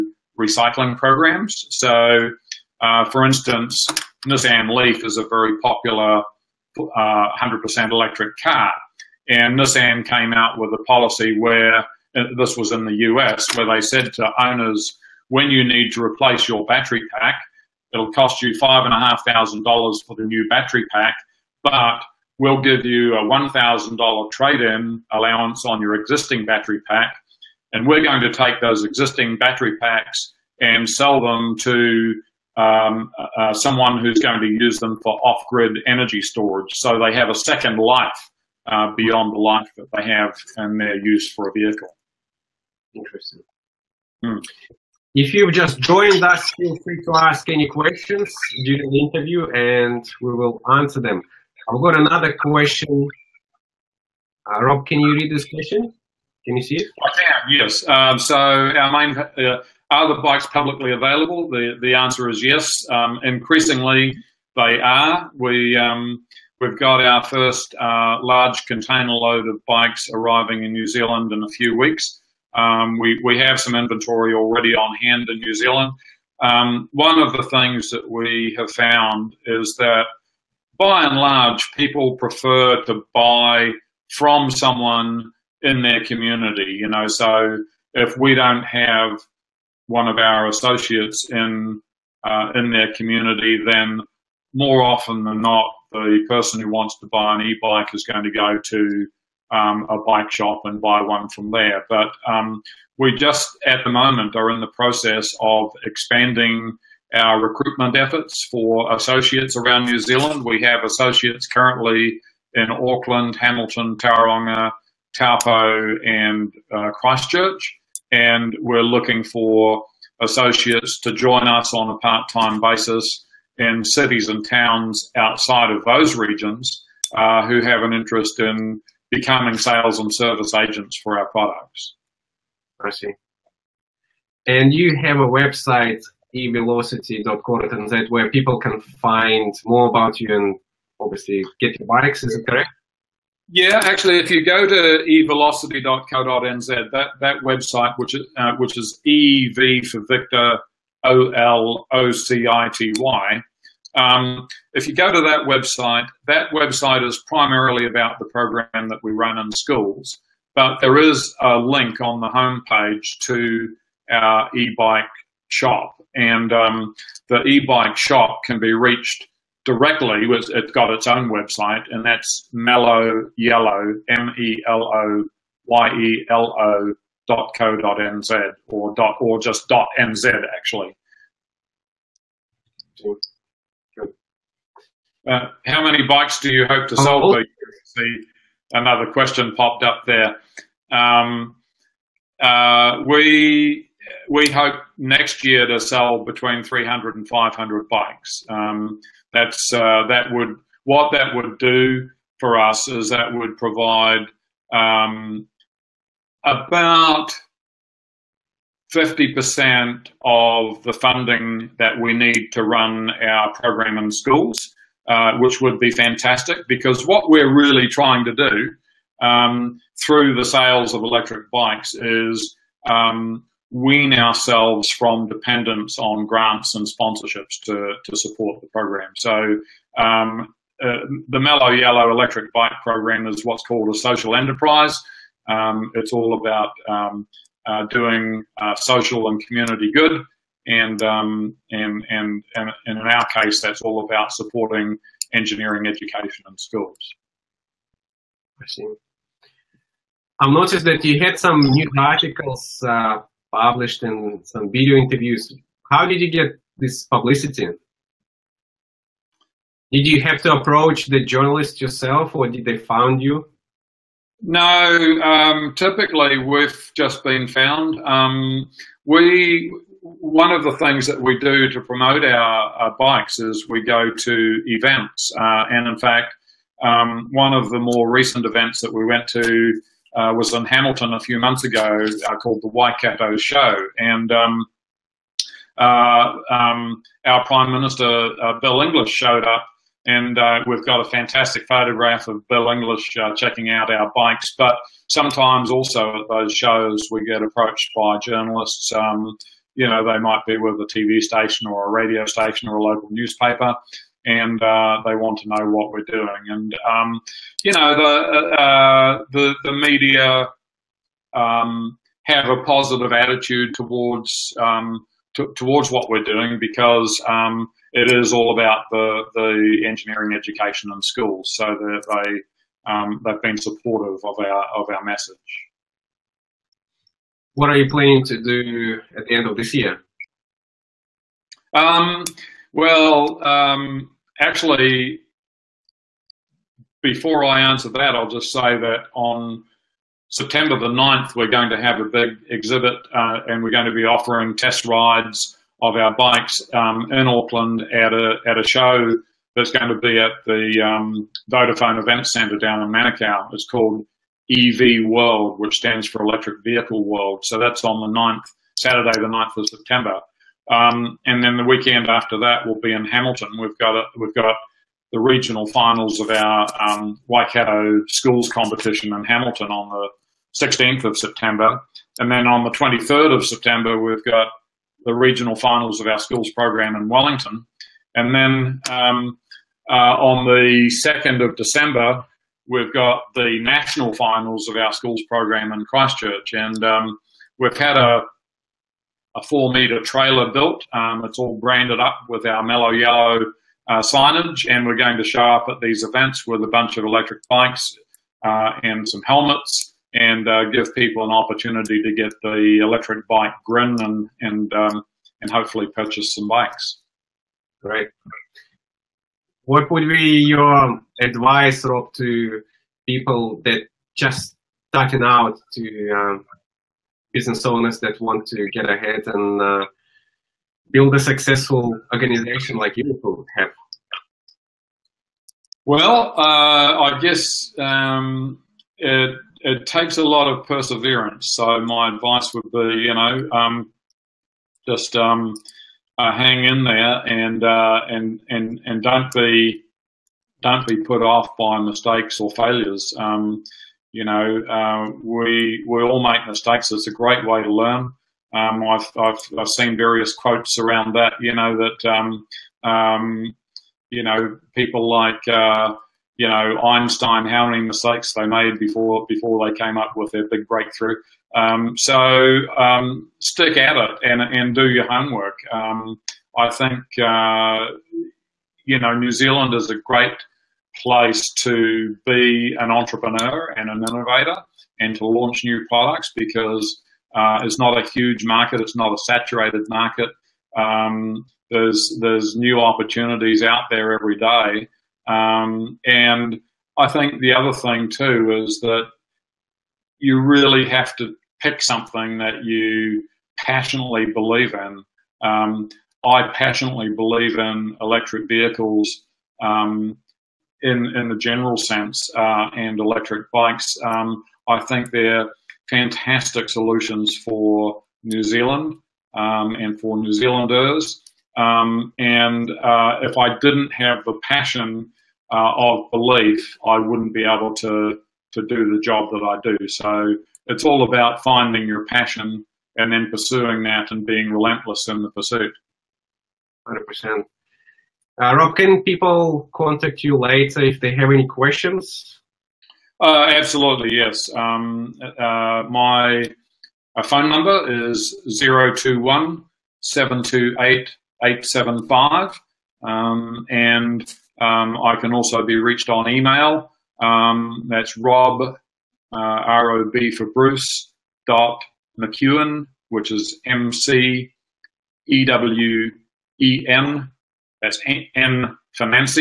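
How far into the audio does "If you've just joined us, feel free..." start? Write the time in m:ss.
0:45.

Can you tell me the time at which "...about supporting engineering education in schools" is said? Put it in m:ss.
4:04.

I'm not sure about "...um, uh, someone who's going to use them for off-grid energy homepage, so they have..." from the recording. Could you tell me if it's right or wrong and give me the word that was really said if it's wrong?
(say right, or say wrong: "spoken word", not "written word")
wrong: "storage", not "homepage".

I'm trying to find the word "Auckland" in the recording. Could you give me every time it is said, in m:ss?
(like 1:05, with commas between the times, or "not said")
1:52, 5:47.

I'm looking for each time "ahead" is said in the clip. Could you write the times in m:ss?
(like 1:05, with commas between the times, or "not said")
6:58.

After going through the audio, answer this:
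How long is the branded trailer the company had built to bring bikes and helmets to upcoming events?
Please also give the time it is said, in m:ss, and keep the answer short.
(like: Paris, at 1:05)
4 meters, at 6:29.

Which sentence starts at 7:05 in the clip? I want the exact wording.
Well, uh, I guess um, it, it, takes a lot of perseverance.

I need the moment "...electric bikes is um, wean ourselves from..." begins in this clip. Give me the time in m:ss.
3:41.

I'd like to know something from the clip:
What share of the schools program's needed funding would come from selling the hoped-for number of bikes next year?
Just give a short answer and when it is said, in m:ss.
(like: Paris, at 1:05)
50%, at 3:28.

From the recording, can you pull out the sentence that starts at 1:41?
But um, we just at the moment are in the process of expanding our recruitment efforts for associates around New Zealand.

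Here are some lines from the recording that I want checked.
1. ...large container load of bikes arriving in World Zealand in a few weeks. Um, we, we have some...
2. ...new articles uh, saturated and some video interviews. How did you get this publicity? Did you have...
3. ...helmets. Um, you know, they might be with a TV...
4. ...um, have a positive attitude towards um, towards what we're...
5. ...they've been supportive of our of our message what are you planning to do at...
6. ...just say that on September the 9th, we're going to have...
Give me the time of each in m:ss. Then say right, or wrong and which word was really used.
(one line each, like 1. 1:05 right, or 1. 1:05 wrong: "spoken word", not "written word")
1. 1:08 wrong: "New", not "World"
2. 4:11 wrong: "published", not "saturated"
3. 4:58 wrong: "journalists", not "helmets"
4. 5:11 right
5. 5:23 right
6. 5:38 right.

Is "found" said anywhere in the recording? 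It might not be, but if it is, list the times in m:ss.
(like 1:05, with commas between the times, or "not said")
1:18, 4:27.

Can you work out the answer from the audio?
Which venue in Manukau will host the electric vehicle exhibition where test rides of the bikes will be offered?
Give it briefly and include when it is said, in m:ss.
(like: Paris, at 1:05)
Vodafone Event Centre, at 5:51.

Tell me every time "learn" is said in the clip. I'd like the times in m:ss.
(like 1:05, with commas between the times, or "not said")
7:27.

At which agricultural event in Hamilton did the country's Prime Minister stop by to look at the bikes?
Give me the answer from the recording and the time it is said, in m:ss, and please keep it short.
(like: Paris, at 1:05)
Waikato Show, at 4:42.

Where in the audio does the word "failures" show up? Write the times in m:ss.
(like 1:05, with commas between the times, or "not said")
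7:22.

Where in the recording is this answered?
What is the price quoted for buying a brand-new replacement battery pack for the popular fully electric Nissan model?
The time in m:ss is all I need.
0:18.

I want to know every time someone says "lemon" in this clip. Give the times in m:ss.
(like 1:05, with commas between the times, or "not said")
not said.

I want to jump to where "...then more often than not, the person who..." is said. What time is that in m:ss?
1:33.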